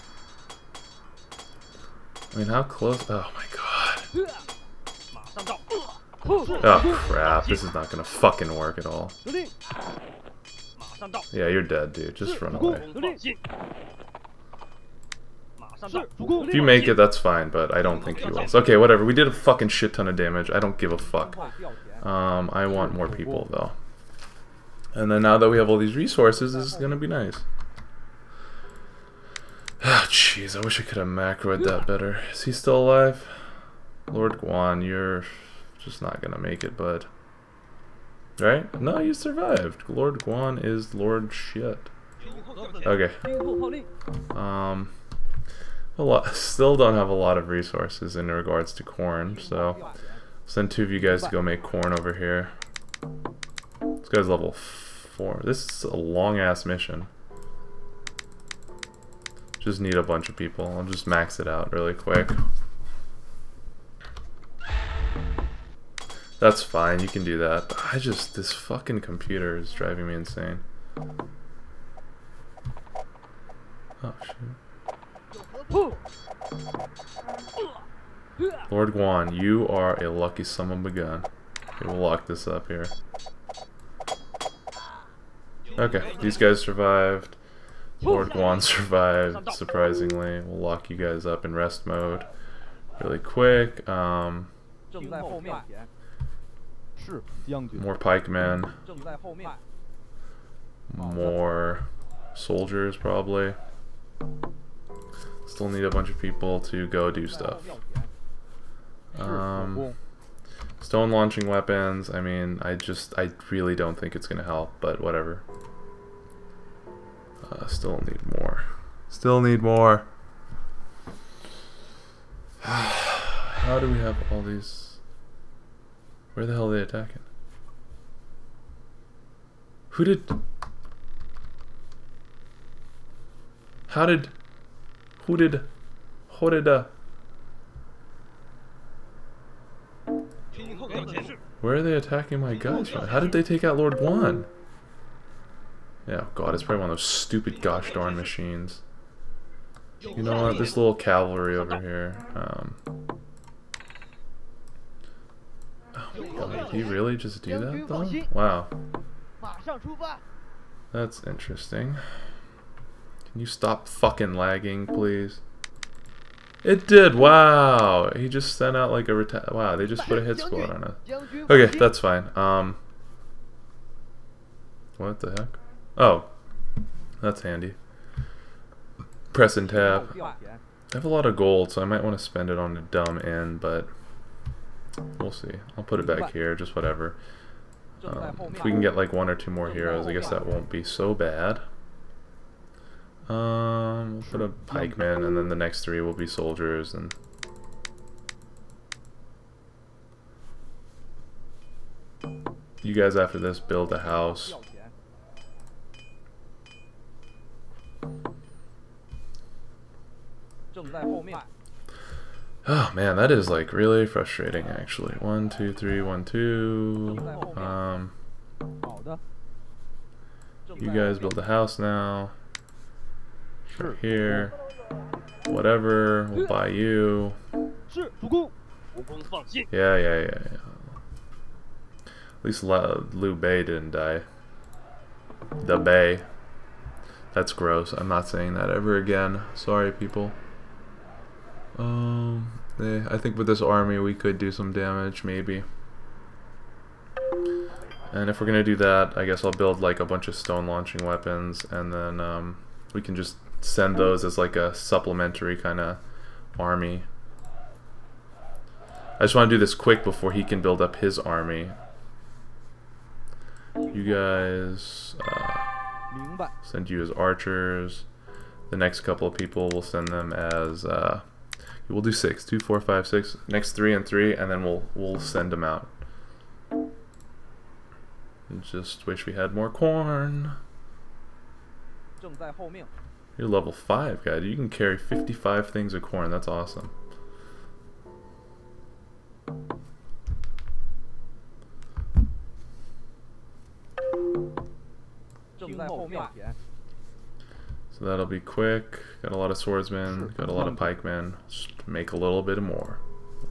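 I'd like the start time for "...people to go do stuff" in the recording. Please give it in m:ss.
1:46.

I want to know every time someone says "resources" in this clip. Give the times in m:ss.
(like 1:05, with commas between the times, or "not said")
0:25, 0:47.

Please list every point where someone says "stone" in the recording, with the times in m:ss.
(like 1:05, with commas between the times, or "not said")
1:50, 4:10.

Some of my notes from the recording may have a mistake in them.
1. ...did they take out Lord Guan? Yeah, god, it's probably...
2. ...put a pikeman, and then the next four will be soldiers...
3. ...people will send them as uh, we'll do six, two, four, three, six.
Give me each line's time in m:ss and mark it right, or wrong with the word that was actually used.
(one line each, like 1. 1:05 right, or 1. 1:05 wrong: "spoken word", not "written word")
1. 2:23 right
2. 3:14 wrong: "three", not "four"
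3. 4:29 wrong: "five", not "three".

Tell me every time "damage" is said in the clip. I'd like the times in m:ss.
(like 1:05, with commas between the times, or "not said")
0:20, 4:04.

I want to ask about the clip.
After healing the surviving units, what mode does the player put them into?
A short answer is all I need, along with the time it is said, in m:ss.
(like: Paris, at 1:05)
Rest mode, at 1:31.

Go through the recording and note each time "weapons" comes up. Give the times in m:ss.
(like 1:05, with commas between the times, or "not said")
1:51, 4:11.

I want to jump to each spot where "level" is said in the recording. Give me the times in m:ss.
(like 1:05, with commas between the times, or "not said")
0:54, 4:43.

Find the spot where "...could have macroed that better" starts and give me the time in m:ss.
0:30.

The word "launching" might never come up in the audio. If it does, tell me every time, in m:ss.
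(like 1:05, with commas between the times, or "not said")
1:51, 4:10.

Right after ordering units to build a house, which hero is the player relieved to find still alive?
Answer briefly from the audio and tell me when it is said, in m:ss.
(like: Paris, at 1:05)
Liu Bei, at 3:52.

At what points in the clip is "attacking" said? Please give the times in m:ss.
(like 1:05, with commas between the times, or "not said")
2:06, 2:21.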